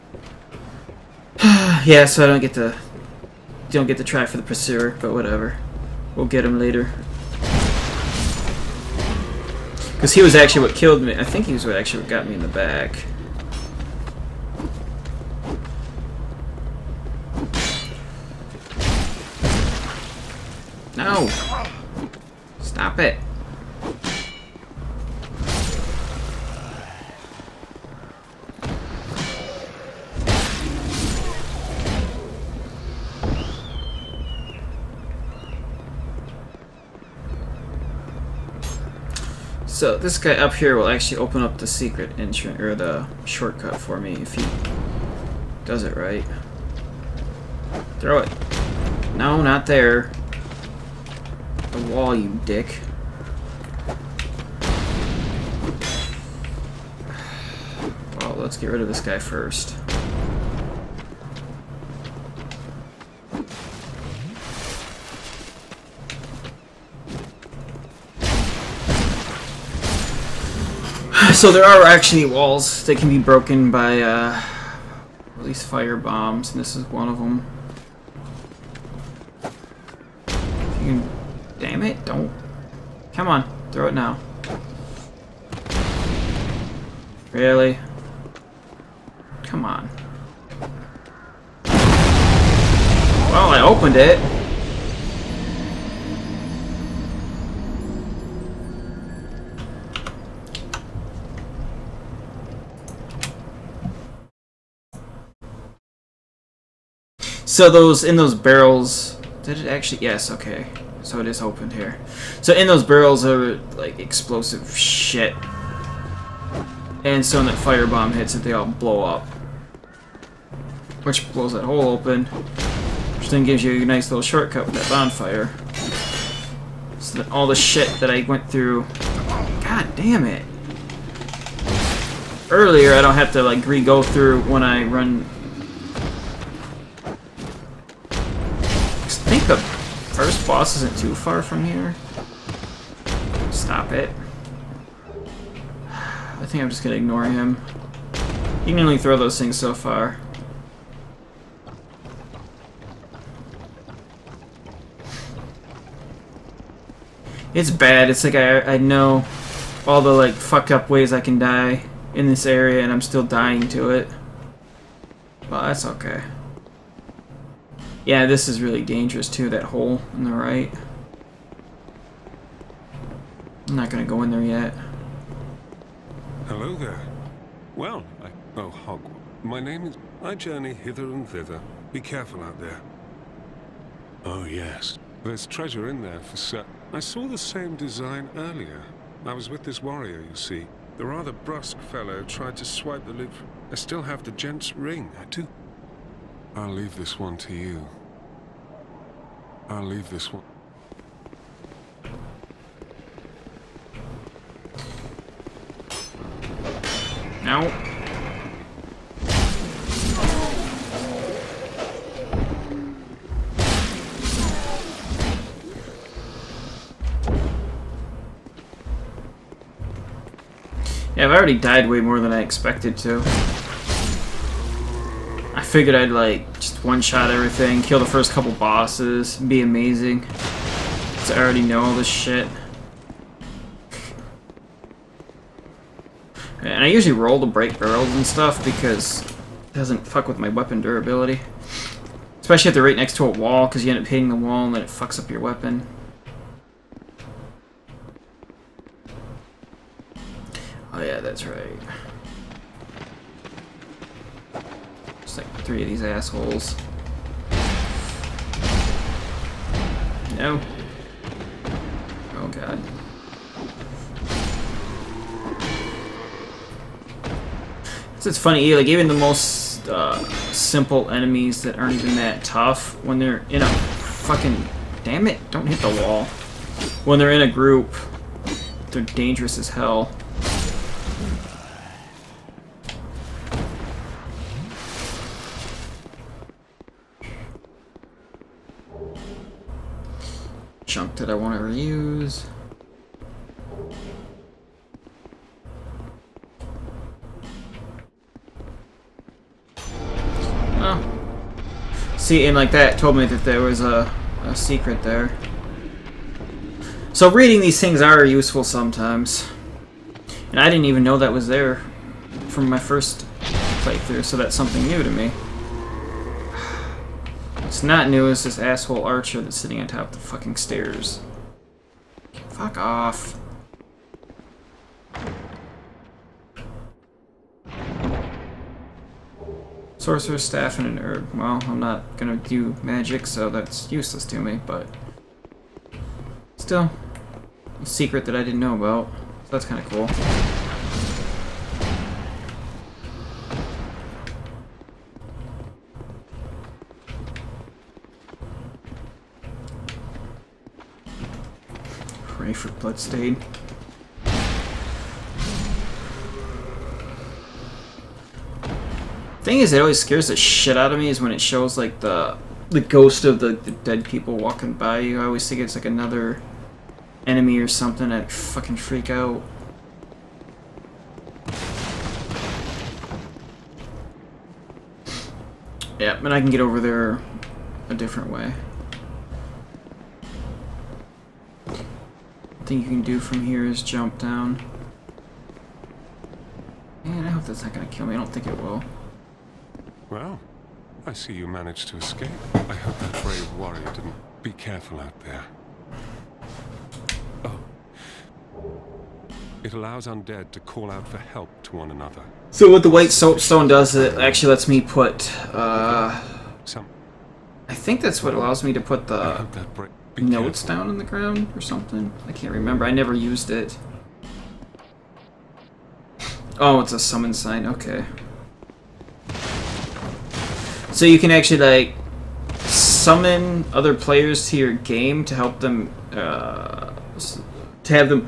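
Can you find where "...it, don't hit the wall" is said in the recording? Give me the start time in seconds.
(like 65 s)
275 s.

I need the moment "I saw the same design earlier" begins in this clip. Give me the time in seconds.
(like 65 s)
186 s.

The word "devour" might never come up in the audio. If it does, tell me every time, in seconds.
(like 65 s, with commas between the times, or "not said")
not said.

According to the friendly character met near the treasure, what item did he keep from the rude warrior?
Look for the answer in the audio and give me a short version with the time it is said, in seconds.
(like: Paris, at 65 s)
The gent's ring, at 194 s.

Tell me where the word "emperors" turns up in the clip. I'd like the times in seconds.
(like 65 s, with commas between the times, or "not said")
not said.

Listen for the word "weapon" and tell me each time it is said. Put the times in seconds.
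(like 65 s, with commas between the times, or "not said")
240 s, 245 s.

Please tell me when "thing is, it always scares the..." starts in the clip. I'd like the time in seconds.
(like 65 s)
359 s.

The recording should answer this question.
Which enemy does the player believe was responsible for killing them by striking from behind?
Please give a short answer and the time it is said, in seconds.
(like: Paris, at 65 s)
The Pursuer, at 4 s.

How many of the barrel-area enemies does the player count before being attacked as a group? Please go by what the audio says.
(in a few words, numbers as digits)
3.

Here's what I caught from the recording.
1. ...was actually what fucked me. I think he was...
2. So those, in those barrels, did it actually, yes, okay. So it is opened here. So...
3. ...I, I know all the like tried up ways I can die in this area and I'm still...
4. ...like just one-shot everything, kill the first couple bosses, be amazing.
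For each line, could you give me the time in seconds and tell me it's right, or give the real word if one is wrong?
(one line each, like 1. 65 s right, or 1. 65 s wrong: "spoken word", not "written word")
1. 10 s wrong: "killed", not "fucked"
2. 107 s right
3. 158 s wrong: "fucked", not "tried"
4. 226 s right.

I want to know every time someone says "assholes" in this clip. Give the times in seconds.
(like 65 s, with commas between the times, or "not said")
256 s, 318 s.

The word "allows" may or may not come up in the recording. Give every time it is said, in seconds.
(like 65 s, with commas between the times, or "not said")
399 s, 408 s.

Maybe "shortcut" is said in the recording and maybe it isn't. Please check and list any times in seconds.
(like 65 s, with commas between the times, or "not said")
43 s, 124 s.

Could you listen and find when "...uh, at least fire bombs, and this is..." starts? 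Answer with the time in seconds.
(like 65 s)
74 s.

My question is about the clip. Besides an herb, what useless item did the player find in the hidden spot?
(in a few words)
Sorcerer's Staff.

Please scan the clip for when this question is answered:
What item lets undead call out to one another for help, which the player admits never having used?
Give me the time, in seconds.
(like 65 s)
402 s.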